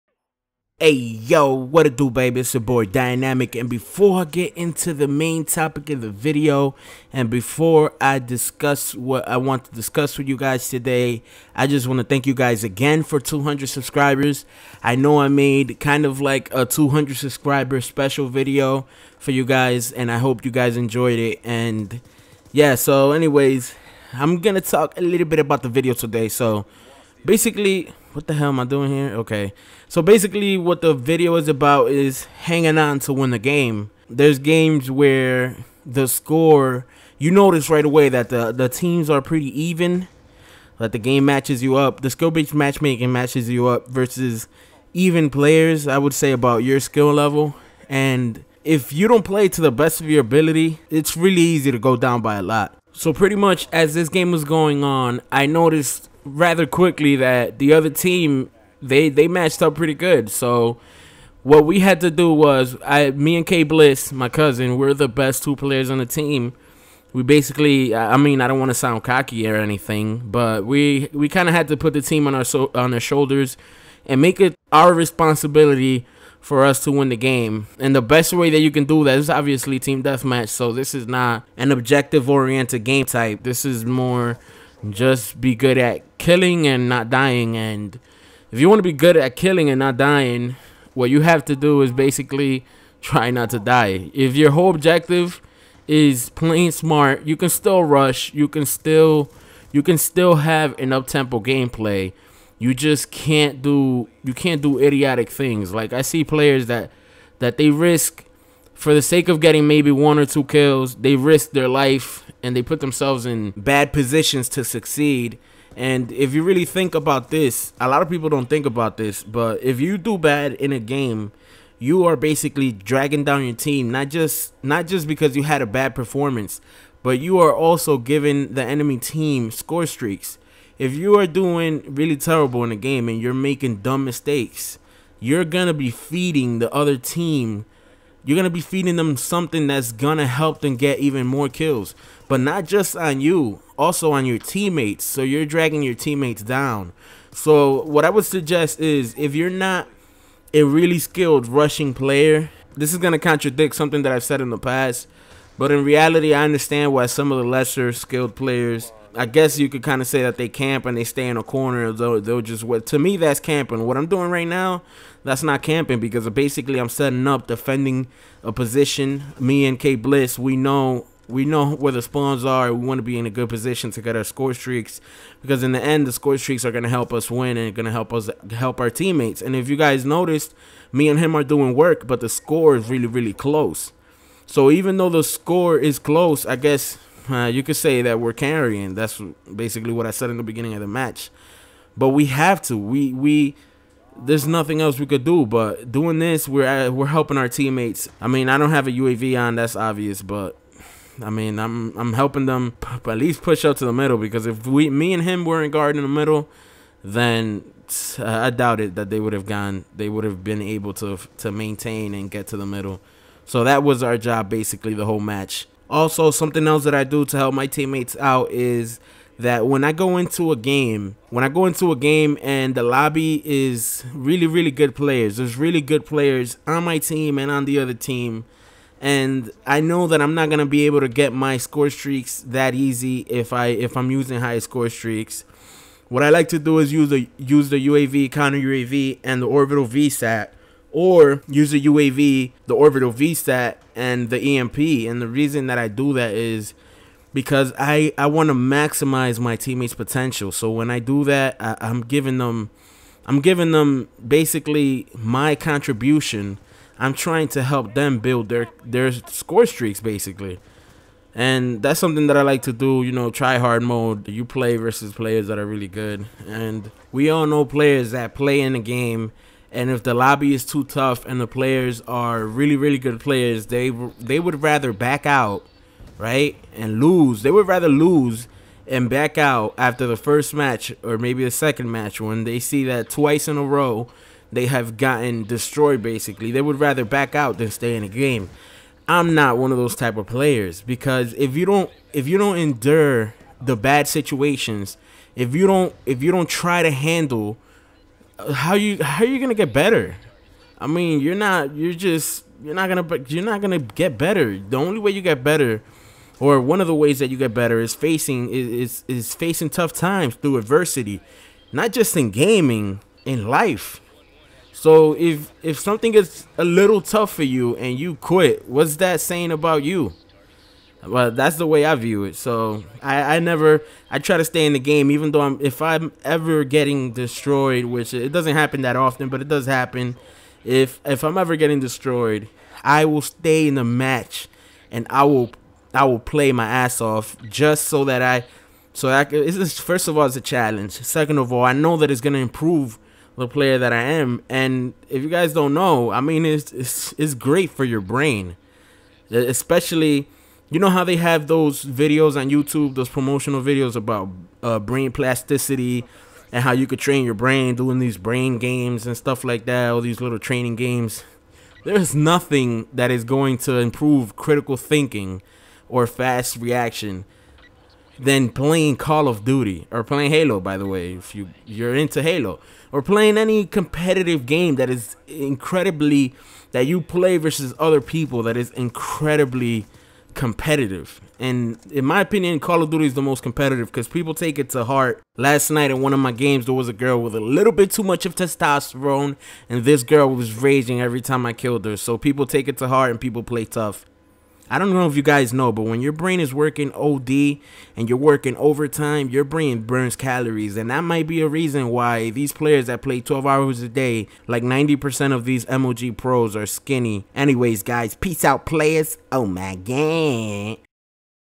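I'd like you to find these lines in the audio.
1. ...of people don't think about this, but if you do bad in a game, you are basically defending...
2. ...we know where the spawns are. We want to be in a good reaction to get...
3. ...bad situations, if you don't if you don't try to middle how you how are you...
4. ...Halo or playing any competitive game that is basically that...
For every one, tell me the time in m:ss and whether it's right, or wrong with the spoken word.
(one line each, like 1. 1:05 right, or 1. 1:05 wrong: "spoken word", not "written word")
1. 1:58 wrong: "dragging", not "defending"
2. 2:51 wrong: "position", not "reaction"
3. 4:53 wrong: "handle", not "middle"
4. 6:12 wrong: "incredibly", not "basically".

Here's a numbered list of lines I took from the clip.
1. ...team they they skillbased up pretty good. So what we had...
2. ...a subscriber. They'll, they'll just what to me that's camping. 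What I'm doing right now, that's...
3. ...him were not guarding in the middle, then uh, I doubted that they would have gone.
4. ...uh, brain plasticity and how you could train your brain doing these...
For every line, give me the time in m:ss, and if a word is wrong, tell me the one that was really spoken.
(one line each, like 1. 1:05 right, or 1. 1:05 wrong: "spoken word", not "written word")
1. 0:57 wrong: "matched", not "skillbased"
2. 2:41 wrong: "corner", not "subscriber"
3. 3:25 right
4. 5:54 right.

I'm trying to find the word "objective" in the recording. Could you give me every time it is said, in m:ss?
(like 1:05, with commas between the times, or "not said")
1:21, 1:34.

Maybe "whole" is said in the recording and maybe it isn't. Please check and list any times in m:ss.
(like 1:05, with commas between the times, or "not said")
1:34, 3:35.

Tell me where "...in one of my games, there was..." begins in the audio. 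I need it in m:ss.
6:25.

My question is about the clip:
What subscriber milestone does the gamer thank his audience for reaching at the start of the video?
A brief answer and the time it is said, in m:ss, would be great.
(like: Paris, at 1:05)
200, at 0:13.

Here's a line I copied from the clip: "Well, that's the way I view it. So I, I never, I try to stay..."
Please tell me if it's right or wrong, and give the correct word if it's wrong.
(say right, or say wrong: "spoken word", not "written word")
right.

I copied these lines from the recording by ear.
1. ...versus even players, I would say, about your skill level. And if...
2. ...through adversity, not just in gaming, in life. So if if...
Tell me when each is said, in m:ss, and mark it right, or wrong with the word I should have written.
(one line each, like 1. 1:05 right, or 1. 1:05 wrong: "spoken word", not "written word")
1. 0:43 right
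2. 5:10 right.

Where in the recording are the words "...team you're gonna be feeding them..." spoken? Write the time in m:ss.
2:16.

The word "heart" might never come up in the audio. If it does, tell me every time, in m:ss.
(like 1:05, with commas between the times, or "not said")
6:24, 6:32.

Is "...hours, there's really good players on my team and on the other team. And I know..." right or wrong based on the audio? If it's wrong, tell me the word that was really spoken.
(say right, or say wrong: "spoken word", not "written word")
wrong: "players", not "hours".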